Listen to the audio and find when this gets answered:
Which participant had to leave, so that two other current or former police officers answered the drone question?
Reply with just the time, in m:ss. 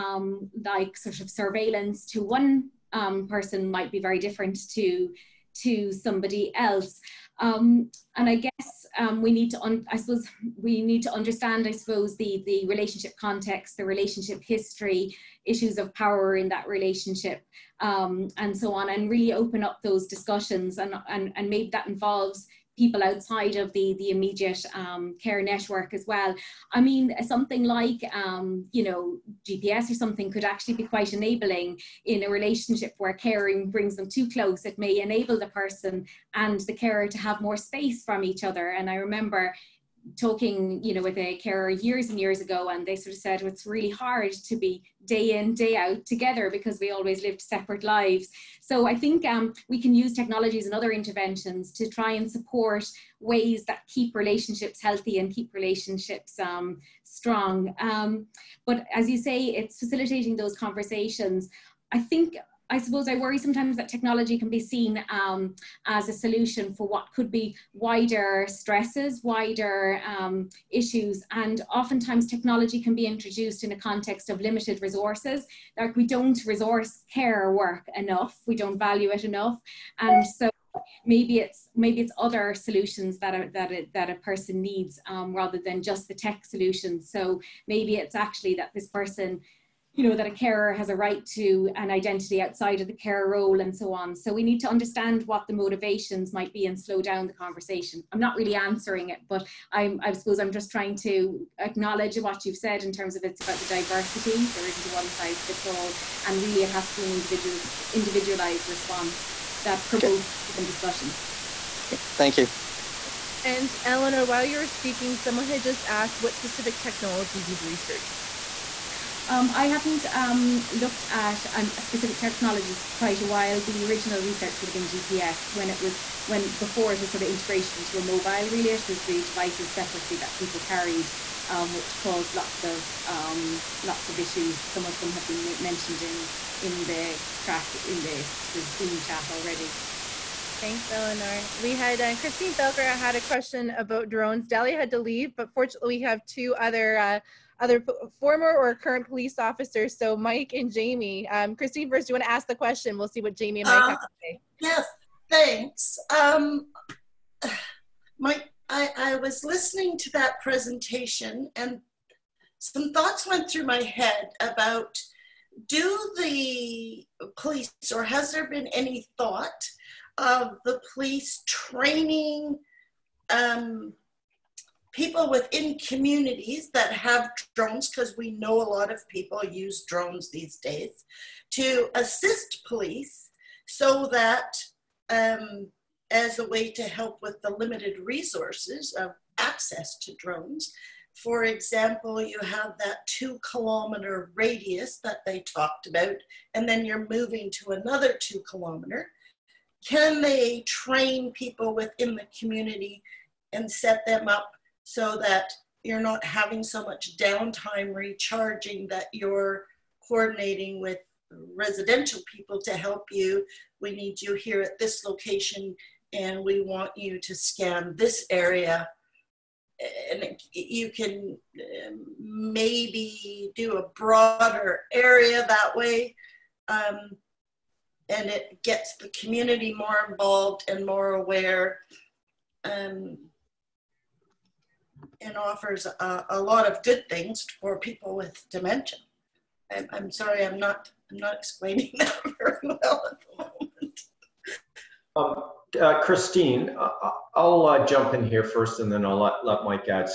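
2:24.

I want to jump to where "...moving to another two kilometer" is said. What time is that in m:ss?
3:17.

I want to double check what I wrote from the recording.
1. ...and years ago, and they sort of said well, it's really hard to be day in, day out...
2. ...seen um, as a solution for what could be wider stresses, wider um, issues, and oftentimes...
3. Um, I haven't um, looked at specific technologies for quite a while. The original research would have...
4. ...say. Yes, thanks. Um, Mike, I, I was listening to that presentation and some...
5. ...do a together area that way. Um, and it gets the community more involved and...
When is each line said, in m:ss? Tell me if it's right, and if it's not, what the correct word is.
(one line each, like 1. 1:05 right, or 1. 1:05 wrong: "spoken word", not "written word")
1. 0:42 right
2. 1:04 right
3. 1:59 right
4. 2:34 right
5. 3:43 wrong: "broader", not "together".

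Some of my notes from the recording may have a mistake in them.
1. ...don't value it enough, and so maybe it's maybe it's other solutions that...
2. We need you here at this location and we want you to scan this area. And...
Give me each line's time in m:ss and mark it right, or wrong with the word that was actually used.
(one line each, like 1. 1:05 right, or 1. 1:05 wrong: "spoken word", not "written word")
1. 1:18 right
2. 3:33 right.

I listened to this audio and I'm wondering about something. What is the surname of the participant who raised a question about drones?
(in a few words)
Thelker.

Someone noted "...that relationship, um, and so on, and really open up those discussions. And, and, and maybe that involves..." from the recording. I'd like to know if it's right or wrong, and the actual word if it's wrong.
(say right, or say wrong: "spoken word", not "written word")
right.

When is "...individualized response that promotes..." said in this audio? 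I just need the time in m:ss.
1:47.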